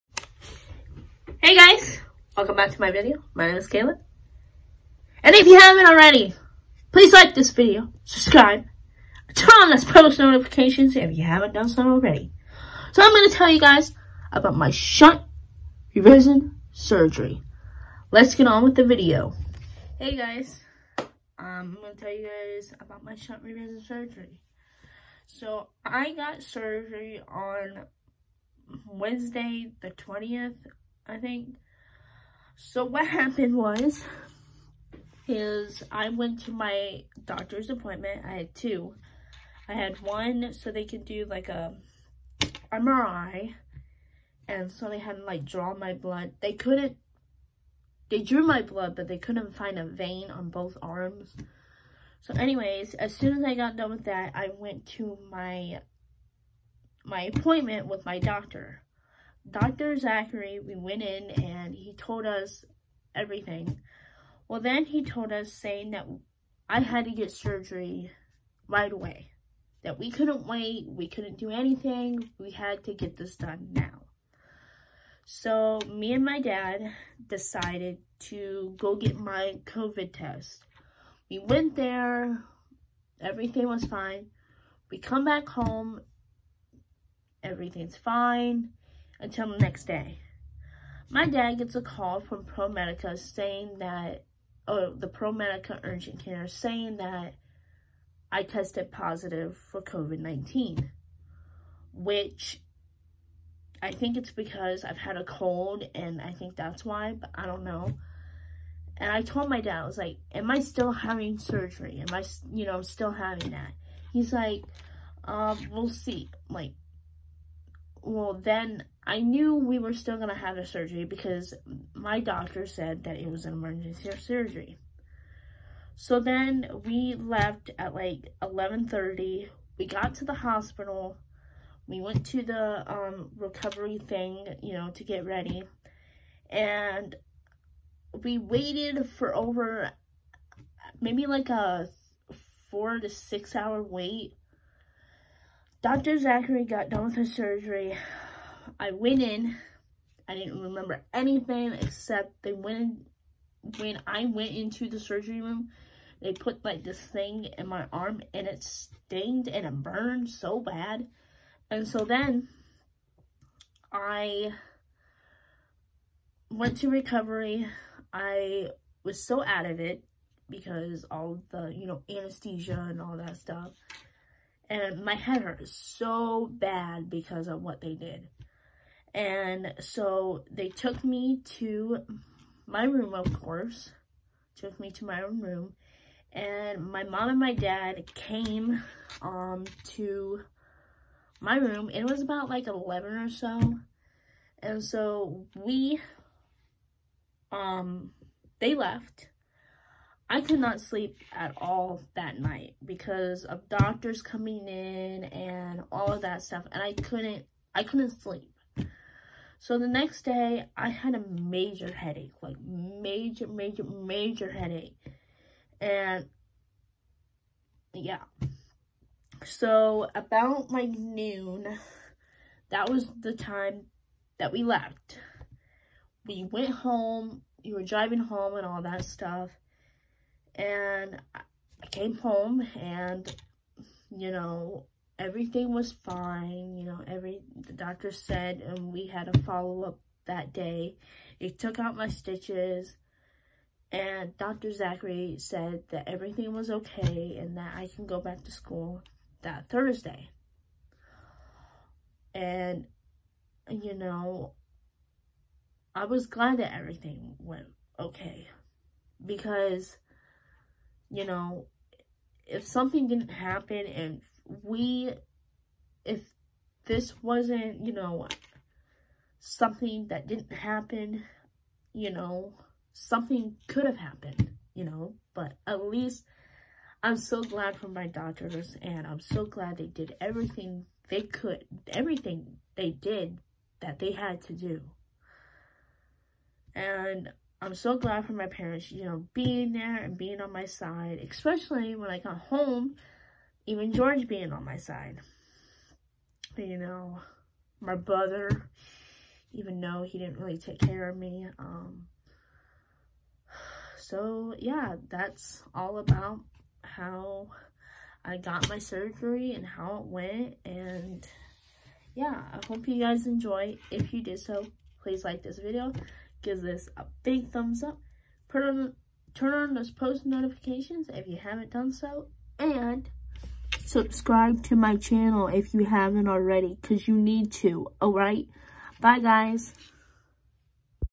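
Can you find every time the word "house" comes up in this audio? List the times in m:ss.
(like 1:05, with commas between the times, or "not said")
not said.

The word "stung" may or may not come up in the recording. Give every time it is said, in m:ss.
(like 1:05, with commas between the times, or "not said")
2:38.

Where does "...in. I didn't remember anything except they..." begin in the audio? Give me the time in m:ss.
2:29.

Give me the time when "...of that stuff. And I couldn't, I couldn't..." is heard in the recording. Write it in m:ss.
3:26.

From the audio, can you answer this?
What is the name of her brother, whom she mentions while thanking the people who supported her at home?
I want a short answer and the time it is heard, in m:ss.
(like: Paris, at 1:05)
George, at 4:53.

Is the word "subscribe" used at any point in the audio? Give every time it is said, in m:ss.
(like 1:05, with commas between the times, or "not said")
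0:08, 5:23.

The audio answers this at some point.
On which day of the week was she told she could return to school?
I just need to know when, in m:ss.
4:09.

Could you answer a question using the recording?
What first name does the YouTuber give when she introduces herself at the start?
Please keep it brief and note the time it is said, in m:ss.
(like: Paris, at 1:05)
Kayla, at 0:03.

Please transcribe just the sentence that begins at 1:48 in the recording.
And I told my dad, I was like, am I still having surgery?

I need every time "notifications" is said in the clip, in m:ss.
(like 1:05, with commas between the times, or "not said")
0:10, 5:20.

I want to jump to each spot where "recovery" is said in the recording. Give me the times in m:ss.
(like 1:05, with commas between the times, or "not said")
2:13, 2:46.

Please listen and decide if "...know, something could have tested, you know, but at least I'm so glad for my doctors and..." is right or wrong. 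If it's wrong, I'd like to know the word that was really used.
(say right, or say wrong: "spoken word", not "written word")
wrong: "happened", not "tested".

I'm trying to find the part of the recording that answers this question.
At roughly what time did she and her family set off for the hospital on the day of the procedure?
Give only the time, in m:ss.
2:08.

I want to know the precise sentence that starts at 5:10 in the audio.
And, yeah, I hope you guys enjoy.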